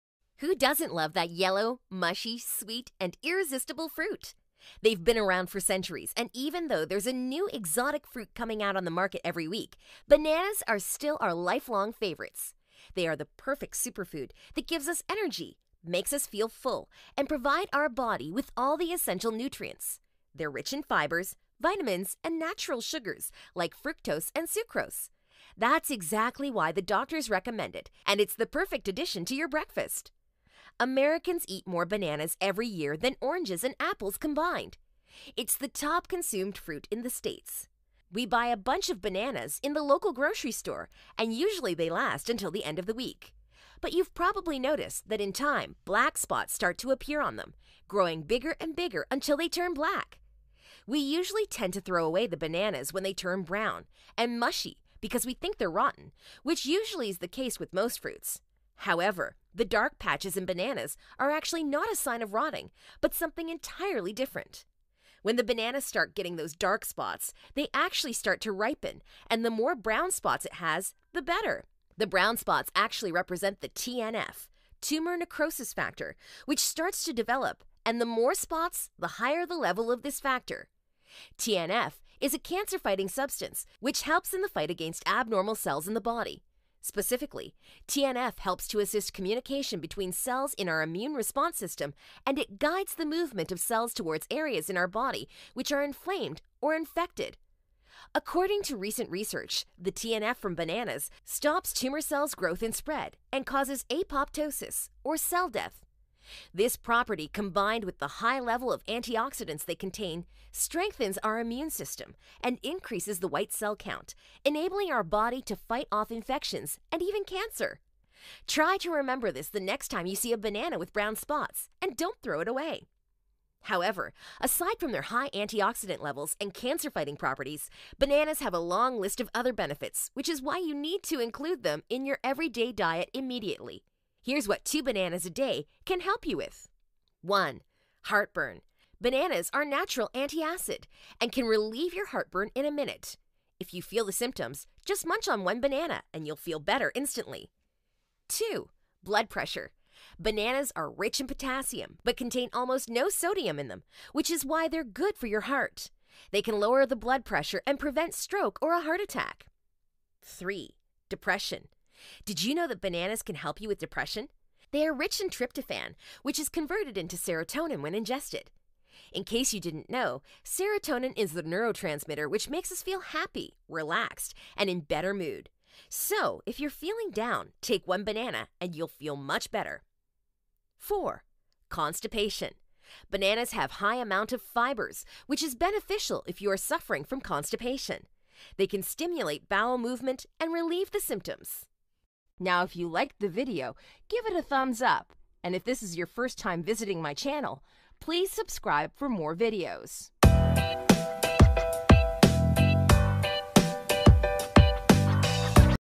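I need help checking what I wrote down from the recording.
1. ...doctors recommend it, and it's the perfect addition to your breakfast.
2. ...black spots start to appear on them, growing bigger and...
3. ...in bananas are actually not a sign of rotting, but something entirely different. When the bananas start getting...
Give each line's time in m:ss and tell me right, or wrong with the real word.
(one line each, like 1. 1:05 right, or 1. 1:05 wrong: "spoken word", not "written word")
1. 0:26 right
2. 0:45 right
3. 1:00 right.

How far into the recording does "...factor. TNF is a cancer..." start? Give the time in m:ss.
1:20.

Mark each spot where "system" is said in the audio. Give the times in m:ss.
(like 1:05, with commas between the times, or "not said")
1:31, 1:51.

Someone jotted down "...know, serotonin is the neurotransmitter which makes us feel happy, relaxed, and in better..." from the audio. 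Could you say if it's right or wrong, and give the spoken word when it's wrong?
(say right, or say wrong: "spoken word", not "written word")
right.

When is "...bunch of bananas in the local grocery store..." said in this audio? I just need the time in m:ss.
0:38.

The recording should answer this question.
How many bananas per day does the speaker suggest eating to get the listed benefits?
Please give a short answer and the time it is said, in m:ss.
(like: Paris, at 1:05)
2, at 2:14.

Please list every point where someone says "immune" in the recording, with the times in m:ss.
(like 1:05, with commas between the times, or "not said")
1:30, 1:51.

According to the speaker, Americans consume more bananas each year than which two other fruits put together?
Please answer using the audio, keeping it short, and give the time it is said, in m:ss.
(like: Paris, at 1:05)
oranges and apples, at 0:33.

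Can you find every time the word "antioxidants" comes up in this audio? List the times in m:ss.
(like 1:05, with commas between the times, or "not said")
1:48, 2:05.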